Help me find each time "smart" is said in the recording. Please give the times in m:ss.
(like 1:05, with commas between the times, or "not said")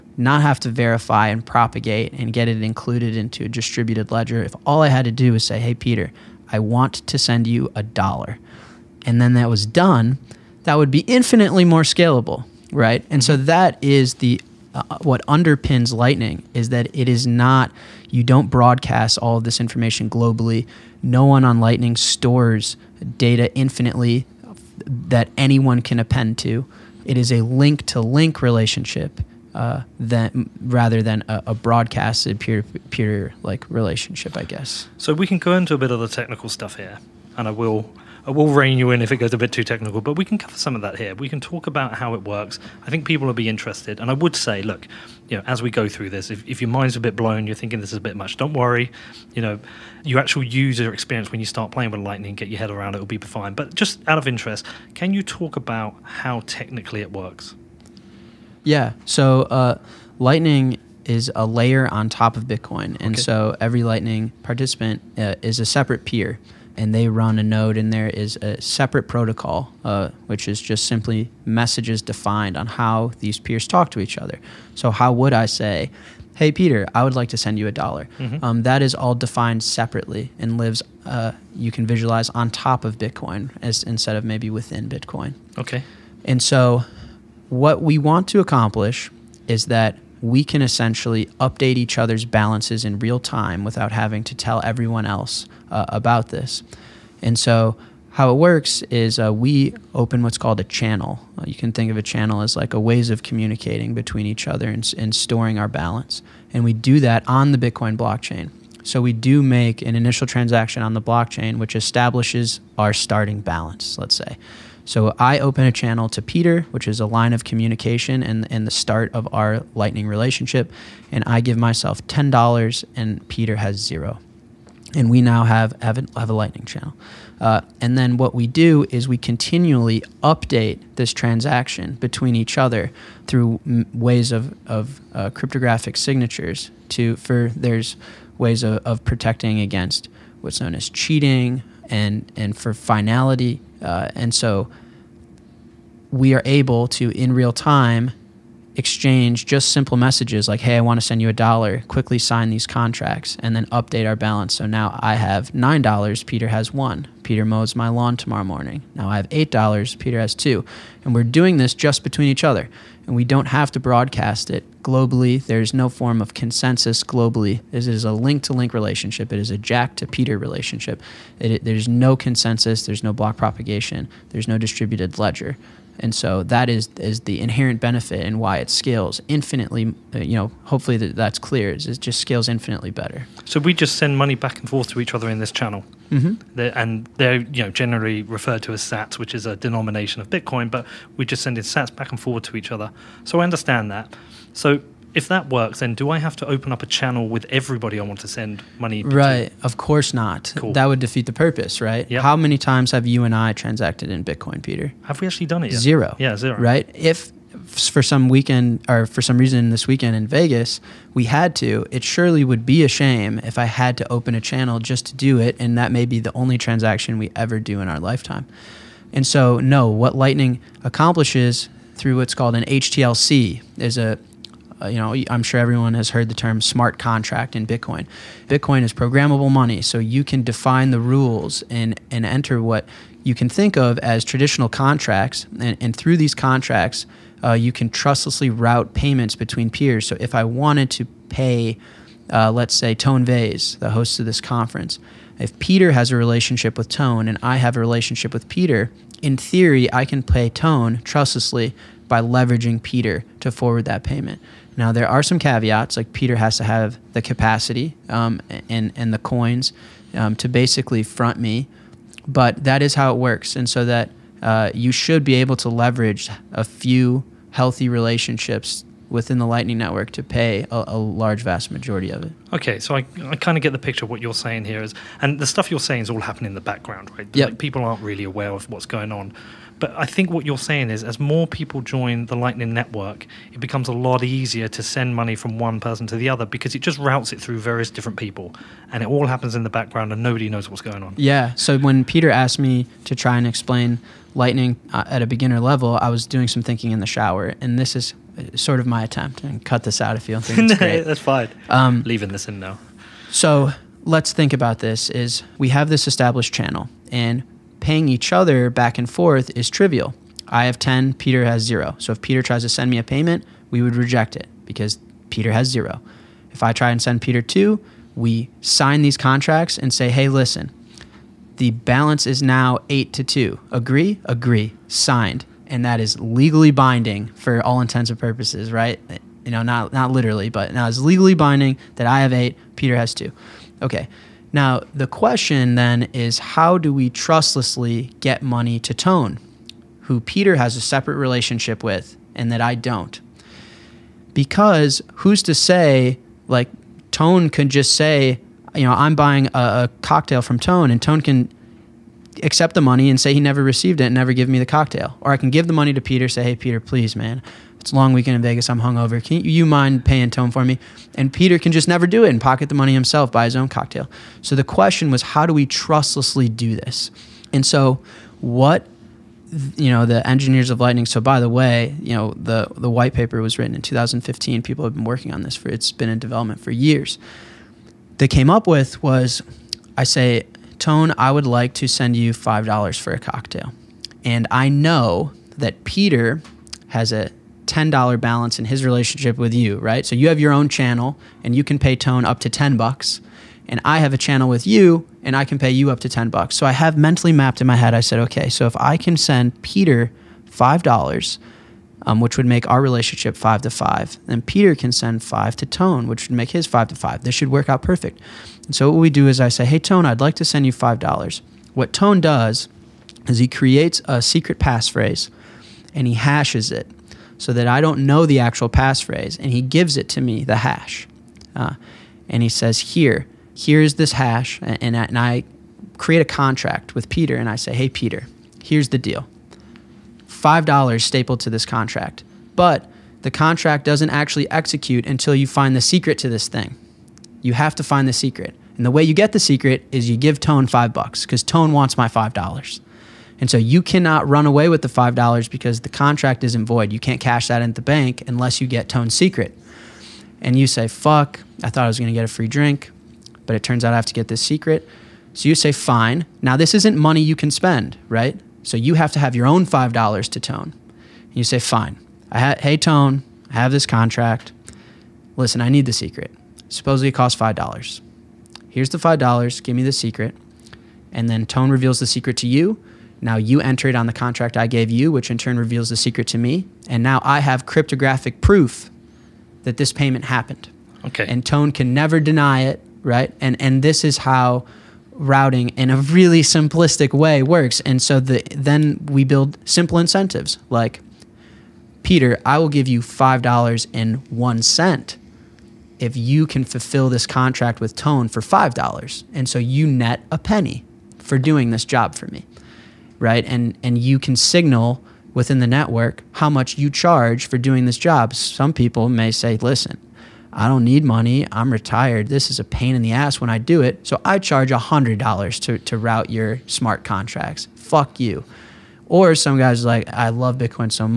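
3:46, 8:36.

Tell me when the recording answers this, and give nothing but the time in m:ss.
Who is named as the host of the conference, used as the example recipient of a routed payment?
4:02.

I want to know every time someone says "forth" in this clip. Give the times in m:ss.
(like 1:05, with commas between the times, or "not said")
3:04, 5:09.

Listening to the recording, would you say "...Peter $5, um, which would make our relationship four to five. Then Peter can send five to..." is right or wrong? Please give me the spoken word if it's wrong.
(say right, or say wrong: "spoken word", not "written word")
wrong: "five", not "four".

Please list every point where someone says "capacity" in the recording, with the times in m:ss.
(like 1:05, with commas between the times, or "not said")
4:17.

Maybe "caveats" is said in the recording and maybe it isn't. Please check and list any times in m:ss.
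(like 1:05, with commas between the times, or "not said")
4:15.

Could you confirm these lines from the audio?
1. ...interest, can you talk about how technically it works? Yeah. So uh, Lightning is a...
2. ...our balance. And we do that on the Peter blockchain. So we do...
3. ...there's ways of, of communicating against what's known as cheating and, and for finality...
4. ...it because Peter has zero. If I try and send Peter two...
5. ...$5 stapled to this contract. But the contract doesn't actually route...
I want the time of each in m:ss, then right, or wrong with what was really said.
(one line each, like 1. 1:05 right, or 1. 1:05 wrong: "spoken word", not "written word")
1. 0:54 right
2. 1:45 wrong: "Bitcoin", not "Peter"
3. 2:17 wrong: "protecting", not "communicating"
4. 5:14 right
5. 7:10 wrong: "execute", not "route".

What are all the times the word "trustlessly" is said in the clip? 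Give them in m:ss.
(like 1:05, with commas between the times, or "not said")
3:57, 4:11, 5:37, 6:05.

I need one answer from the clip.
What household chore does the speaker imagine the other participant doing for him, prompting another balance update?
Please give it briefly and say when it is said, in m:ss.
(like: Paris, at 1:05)
Mows my lawn, at 2:37.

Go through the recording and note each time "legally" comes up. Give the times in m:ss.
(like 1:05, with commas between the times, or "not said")
5:26, 5:30.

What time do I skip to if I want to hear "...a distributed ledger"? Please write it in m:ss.
0:03.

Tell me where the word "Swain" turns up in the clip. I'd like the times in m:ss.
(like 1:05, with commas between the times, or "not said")
not said.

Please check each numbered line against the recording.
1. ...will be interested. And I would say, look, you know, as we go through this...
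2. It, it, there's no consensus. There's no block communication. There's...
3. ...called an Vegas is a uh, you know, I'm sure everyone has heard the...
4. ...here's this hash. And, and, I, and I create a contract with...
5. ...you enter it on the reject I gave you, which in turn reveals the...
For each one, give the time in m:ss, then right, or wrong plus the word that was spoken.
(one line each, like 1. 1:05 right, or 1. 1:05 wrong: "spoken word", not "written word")
1. 0:43 right
2. 2:51 wrong: "propagation", not "communication"
3. 3:42 wrong: "HTLC", not "Vegas"
4. 7:03 right
5. 7:53 wrong: "contract", not "reject".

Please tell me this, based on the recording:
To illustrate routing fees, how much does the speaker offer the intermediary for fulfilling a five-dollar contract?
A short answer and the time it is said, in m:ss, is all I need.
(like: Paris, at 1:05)
$5.01, at 8:12.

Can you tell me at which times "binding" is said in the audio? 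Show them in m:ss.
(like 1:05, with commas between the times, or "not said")
5:26, 5:31.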